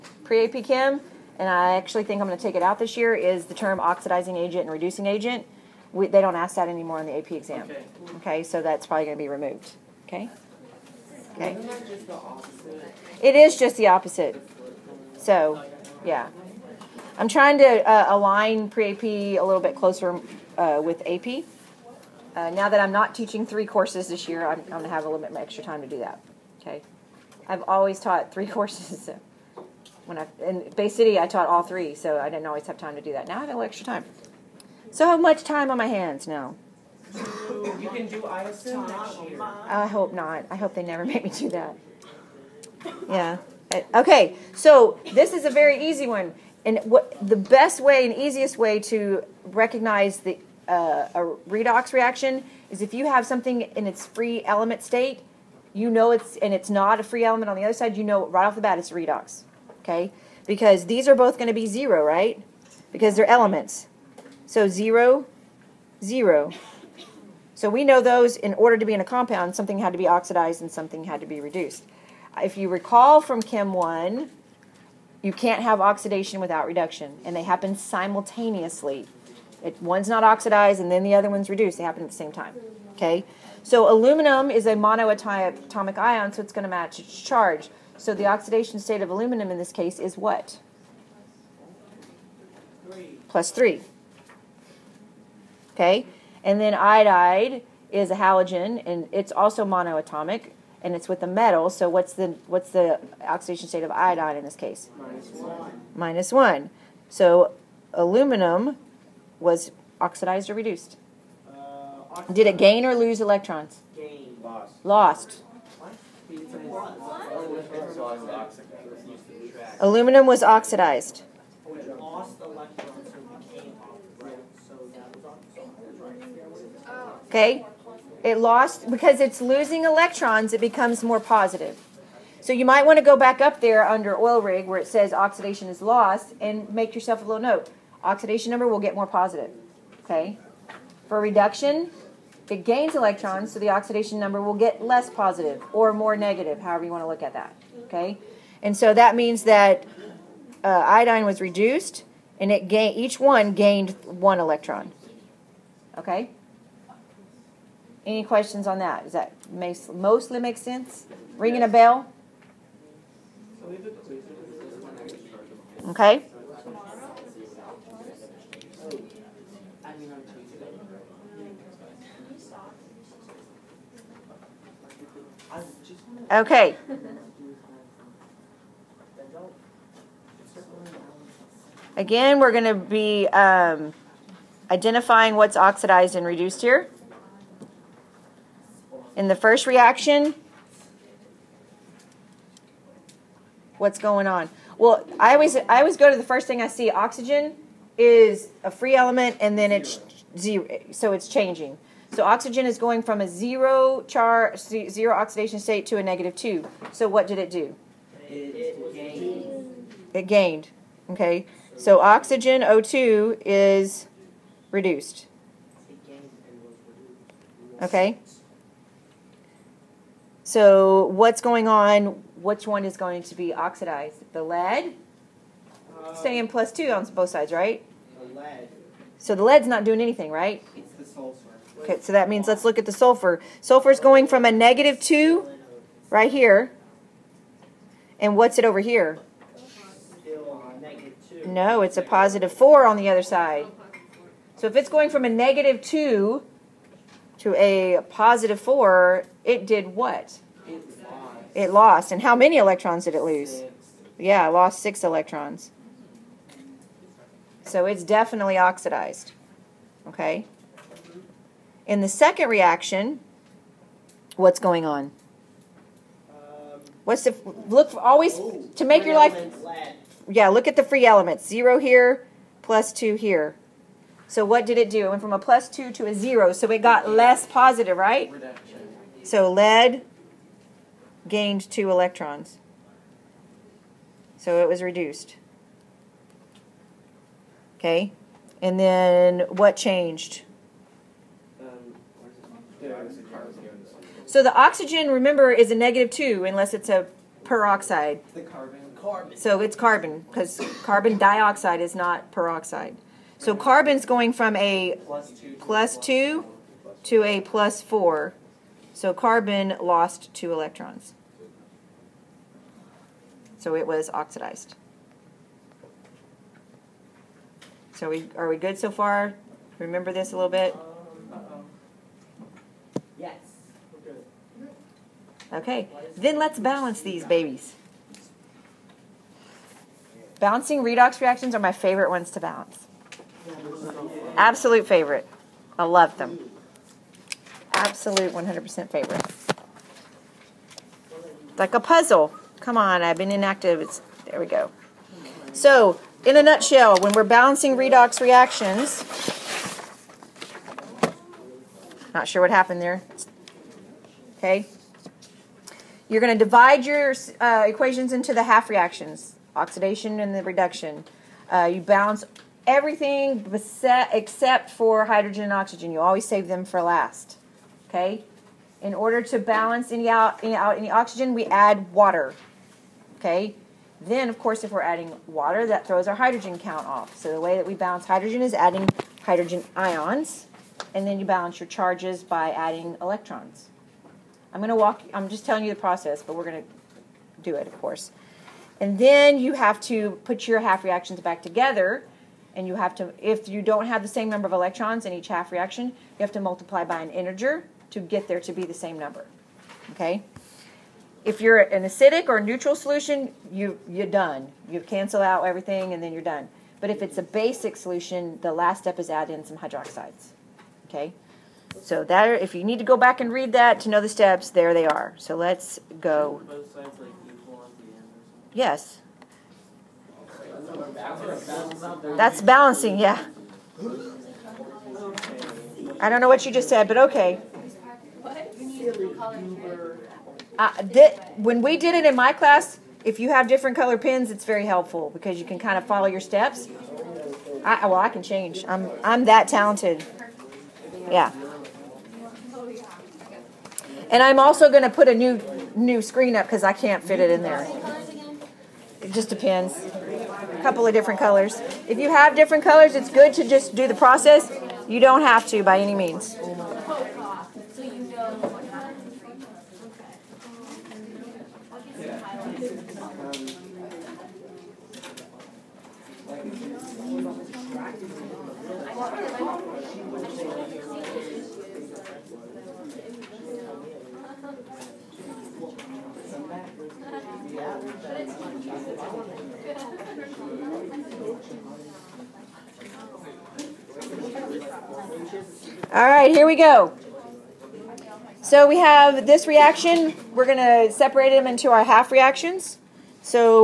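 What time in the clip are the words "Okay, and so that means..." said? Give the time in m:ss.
2:27.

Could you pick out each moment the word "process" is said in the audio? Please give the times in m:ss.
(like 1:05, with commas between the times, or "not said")
6:25, 7:33.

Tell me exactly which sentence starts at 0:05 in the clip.
We, they don't ask that anymore on the AP exam.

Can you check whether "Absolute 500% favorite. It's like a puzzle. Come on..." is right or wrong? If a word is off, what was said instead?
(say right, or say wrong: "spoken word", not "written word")
wrong: "100", not "500".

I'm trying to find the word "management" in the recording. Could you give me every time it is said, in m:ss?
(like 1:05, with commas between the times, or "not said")
not said.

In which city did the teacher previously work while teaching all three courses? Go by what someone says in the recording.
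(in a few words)
Bay City.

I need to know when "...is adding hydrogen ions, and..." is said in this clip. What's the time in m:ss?
6:18.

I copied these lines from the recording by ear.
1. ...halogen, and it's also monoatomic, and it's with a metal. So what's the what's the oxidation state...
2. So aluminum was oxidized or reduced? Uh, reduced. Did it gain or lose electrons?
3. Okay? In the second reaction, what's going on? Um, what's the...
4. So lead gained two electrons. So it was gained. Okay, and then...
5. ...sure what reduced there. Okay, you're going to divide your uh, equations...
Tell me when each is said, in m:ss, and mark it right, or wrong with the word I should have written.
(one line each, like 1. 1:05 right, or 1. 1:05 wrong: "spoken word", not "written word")
1. 1:38 right
2. 1:47 wrong: "oxidized", not "reduced"
3. 4:20 right
4. 4:39 wrong: "reduced", not "gained"
5. 5:52 wrong: "happened", not "reduced".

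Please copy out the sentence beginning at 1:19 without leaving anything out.
It, one's not oxidized and then the other one's reduced.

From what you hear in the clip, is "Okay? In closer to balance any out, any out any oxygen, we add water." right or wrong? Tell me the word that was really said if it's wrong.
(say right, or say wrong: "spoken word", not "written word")
wrong: "order", not "closer".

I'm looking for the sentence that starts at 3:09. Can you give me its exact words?
In the first reaction, what's going on?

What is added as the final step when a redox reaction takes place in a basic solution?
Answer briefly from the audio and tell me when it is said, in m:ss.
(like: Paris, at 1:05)
hydroxides, at 6:49.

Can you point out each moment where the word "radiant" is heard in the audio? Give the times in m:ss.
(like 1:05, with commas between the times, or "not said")
not said.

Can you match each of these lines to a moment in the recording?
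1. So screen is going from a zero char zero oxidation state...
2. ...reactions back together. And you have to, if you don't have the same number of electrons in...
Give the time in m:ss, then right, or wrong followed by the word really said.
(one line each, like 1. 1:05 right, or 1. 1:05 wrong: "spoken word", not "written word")
1. 3:22 wrong: "oxygen", not "screen"
2. 6:30 right.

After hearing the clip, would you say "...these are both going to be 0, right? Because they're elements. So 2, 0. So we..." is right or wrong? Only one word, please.
wrong.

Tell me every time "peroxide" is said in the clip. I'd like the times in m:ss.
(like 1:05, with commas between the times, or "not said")
4:57, 5:02.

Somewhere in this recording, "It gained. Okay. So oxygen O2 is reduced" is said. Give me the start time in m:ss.
3:30.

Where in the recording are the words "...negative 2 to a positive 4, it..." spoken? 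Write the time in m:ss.
4:05.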